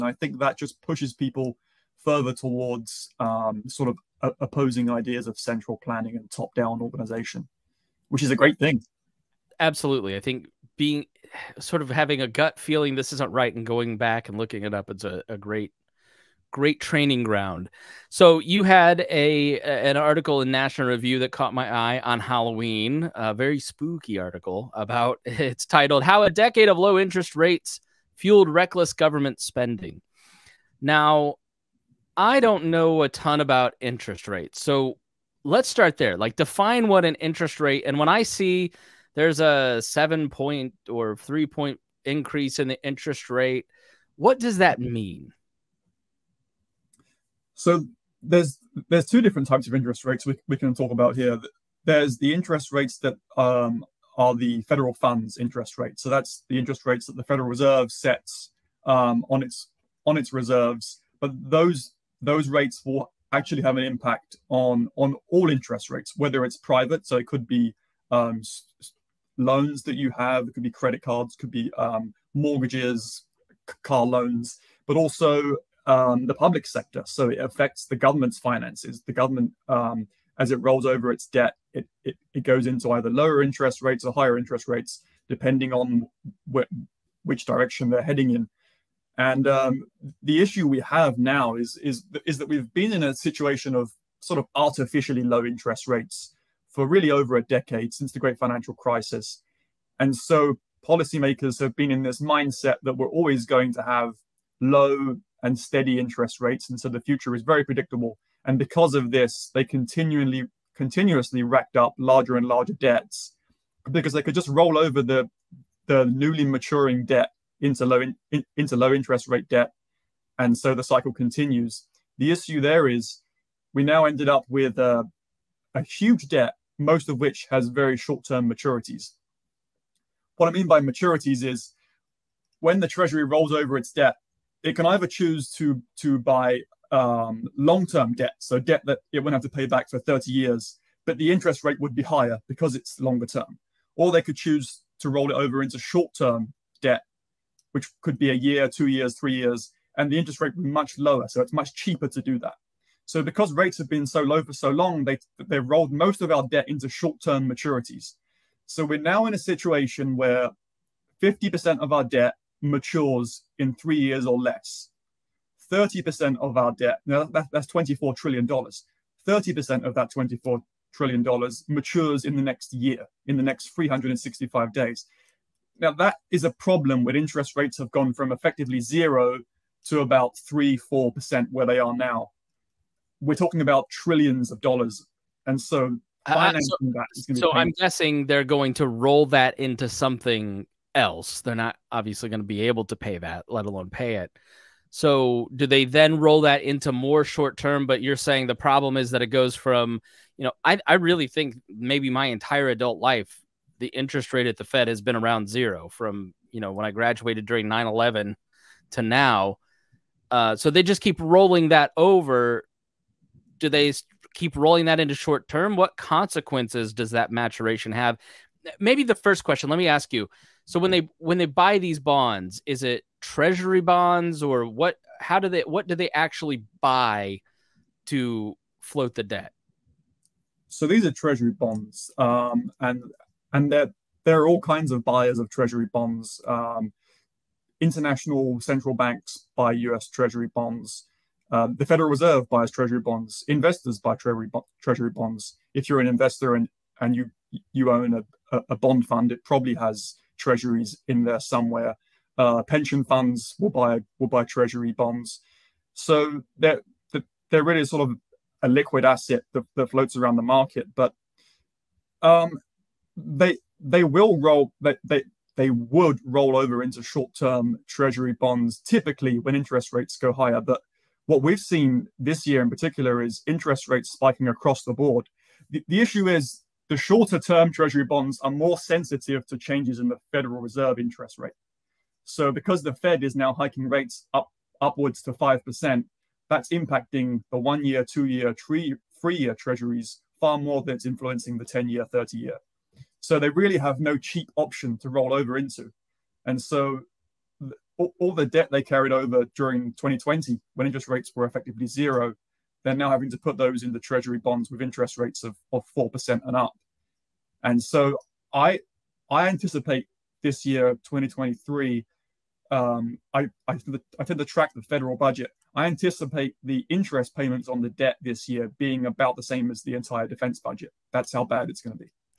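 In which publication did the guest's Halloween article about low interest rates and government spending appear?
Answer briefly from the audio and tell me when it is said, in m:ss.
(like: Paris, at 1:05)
National Review, at 0:20.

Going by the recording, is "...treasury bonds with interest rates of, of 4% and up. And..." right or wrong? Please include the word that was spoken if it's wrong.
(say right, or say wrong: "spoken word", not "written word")
right.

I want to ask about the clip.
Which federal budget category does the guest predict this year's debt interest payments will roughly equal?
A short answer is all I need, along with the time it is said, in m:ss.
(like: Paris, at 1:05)
defense budget, at 5:20.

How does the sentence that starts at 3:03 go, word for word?
We're talking about trillions of dollars.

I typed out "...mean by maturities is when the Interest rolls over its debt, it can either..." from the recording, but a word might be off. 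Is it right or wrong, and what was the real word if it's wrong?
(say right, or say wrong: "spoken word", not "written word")
wrong: "Treasury", not "Interest".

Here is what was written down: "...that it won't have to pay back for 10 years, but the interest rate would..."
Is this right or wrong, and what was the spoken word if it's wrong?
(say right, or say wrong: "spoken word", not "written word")
wrong: "30", not "10".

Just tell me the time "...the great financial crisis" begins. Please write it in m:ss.
1:38.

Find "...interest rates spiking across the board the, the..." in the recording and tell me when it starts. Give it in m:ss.
4:33.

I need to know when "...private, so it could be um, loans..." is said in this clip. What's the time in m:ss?
1:06.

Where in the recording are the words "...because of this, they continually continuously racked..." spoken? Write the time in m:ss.
1:48.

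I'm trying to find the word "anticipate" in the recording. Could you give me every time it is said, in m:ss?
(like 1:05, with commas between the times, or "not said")
5:09, 5:15.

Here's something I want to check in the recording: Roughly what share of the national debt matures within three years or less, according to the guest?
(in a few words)
50%.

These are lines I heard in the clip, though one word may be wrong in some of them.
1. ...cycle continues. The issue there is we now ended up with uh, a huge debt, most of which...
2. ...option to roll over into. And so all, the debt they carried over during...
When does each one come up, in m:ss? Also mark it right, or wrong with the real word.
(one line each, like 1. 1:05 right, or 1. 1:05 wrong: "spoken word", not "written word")
1. 2:00 right
2. 4:54 right.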